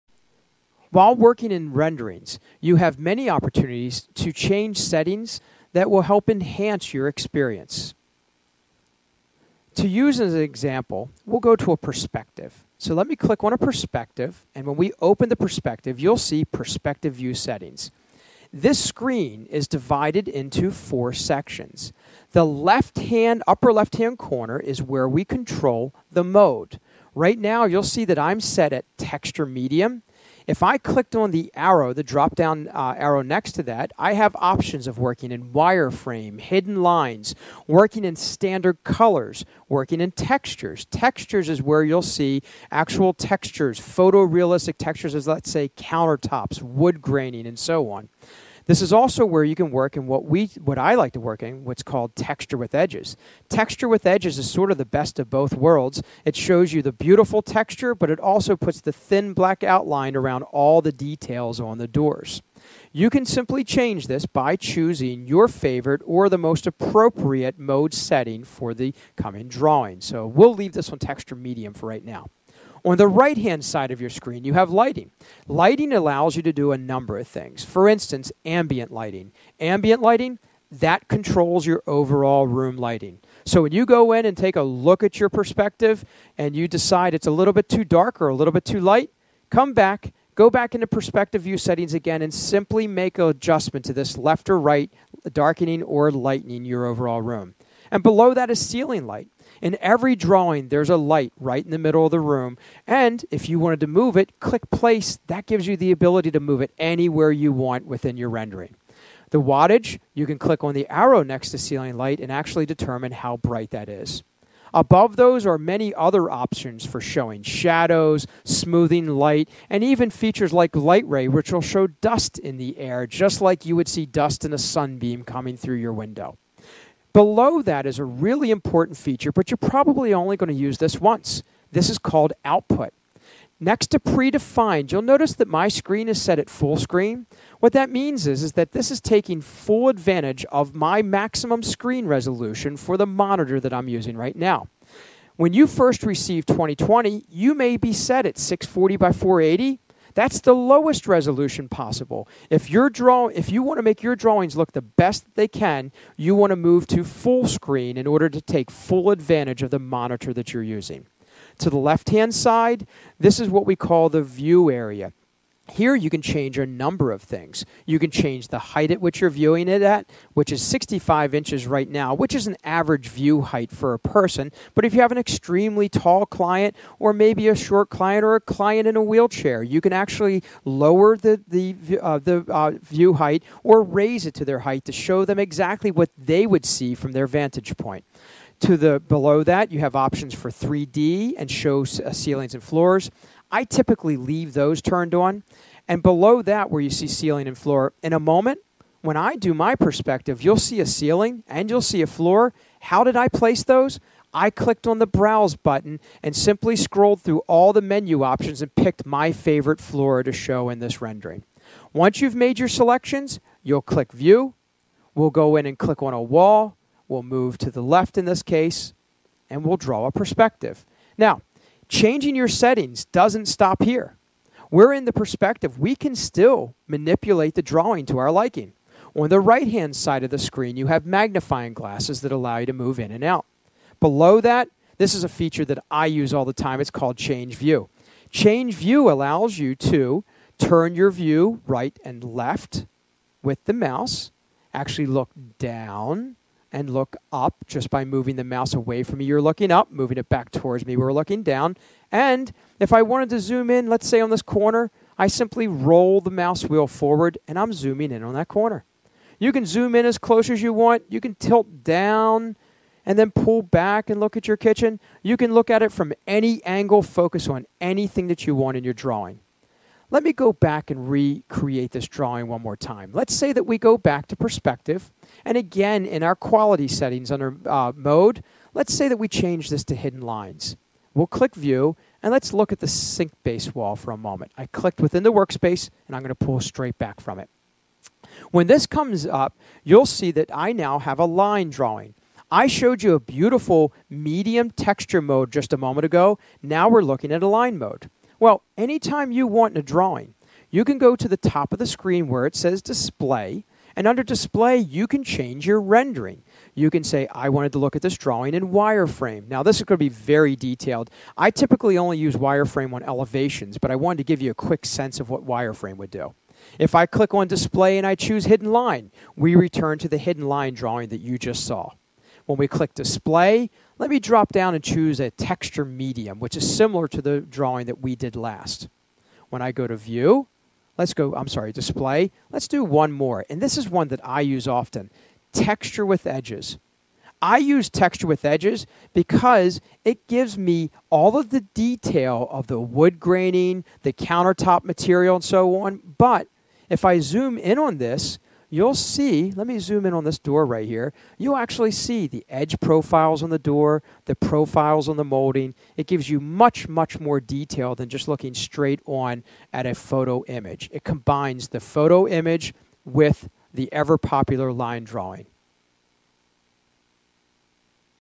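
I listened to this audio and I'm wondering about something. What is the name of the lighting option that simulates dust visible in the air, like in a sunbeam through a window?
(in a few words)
light ray.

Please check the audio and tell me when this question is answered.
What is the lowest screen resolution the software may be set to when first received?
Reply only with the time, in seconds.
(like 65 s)
148 s.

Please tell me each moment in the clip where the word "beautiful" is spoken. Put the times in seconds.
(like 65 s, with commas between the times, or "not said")
56 s, 293 s.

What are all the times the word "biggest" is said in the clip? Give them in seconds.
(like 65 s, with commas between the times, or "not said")
not said.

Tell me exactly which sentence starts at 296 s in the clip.
Now we're looking at a line mode.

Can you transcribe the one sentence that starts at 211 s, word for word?
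Once you've made your selections, you'll click view.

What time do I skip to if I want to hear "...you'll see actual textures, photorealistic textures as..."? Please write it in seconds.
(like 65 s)
41 s.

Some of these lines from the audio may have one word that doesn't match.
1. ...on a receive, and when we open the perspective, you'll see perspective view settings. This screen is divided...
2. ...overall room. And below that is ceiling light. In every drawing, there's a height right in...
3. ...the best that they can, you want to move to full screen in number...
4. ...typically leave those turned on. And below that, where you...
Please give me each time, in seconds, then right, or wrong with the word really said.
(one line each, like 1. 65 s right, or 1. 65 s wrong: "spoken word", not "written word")
1. 13 s wrong: "perspective", not "receive"
2. 96 s wrong: "light", not "height"
3. 154 s wrong: "order", not "number"
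4. 193 s right.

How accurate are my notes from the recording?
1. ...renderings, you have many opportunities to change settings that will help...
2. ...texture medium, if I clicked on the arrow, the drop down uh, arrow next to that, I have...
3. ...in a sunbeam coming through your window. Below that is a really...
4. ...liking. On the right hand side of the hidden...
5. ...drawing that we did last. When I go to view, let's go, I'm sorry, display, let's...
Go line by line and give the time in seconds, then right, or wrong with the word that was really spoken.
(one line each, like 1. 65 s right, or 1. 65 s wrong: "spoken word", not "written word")
1. 1 s right
2. 28 s right
3. 124 s right
4. 228 s wrong: "screen", not "hidden"
5. 327 s right.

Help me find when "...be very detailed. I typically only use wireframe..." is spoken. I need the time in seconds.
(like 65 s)
310 s.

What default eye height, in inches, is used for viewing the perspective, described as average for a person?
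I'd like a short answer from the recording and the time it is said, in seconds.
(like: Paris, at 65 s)
65, at 170 s.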